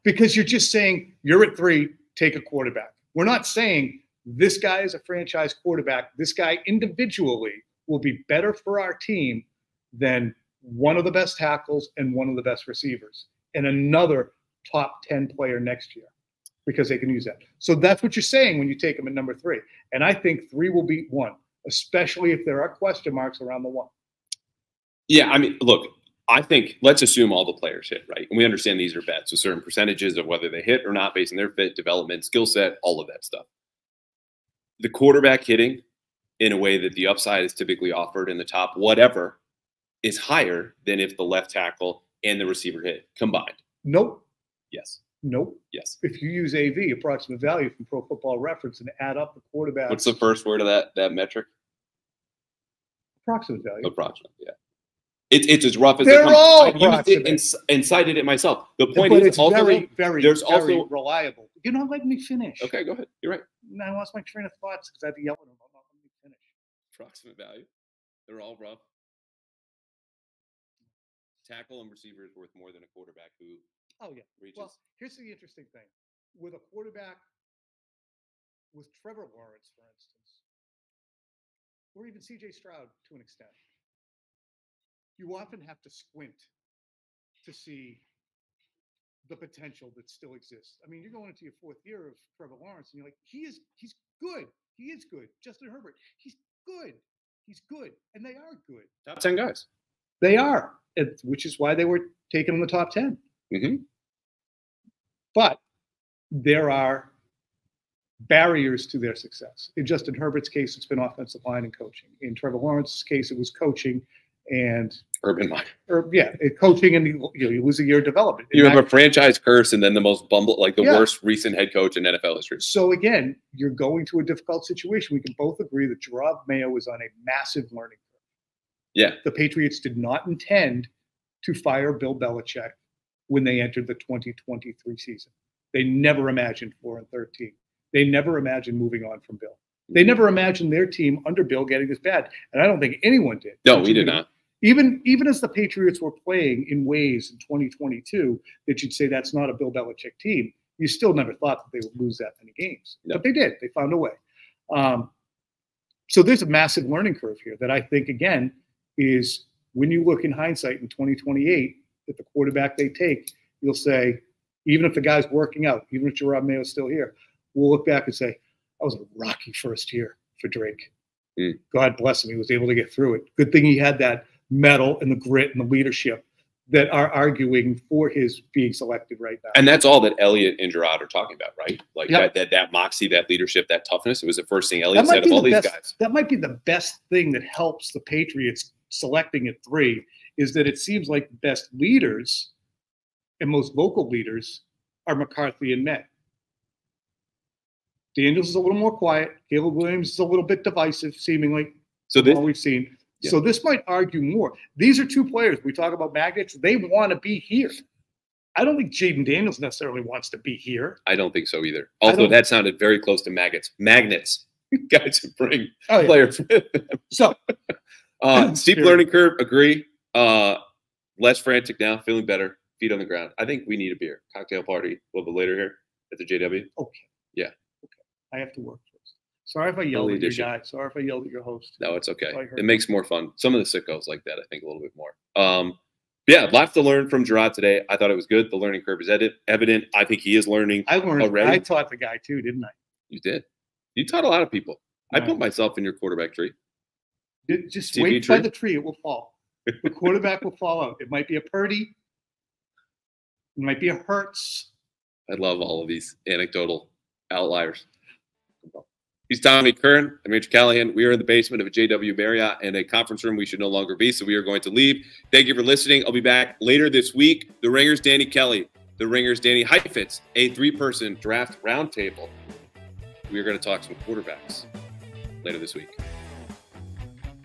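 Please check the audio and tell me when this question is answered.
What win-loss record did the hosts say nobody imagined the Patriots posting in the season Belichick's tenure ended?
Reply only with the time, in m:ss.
2:16.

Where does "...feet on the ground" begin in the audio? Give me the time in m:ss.
3:42.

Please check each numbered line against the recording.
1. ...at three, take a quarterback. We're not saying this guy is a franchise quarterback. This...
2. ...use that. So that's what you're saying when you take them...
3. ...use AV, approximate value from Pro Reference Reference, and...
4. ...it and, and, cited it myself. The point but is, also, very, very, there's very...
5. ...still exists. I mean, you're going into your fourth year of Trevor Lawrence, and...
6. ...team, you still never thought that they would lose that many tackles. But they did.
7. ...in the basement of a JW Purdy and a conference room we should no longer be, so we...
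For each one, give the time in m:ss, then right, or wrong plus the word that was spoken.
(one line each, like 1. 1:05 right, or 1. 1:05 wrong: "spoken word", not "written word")
1. 0:01 right
2. 0:17 right
3. 0:46 wrong: "Football", not "Reference"
4. 0:57 right
5. 1:30 right
6. 2:30 wrong: "games", not "tackles"
7. 4:21 wrong: "Marriott", not "Purdy".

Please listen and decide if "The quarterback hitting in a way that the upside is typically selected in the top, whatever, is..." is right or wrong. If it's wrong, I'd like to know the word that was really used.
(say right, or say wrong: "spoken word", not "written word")
wrong: "offered", not "selected".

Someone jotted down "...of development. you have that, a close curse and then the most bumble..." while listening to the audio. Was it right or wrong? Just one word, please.
wrong.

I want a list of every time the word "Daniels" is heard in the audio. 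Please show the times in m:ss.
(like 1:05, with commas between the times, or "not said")
3:18, 3:29.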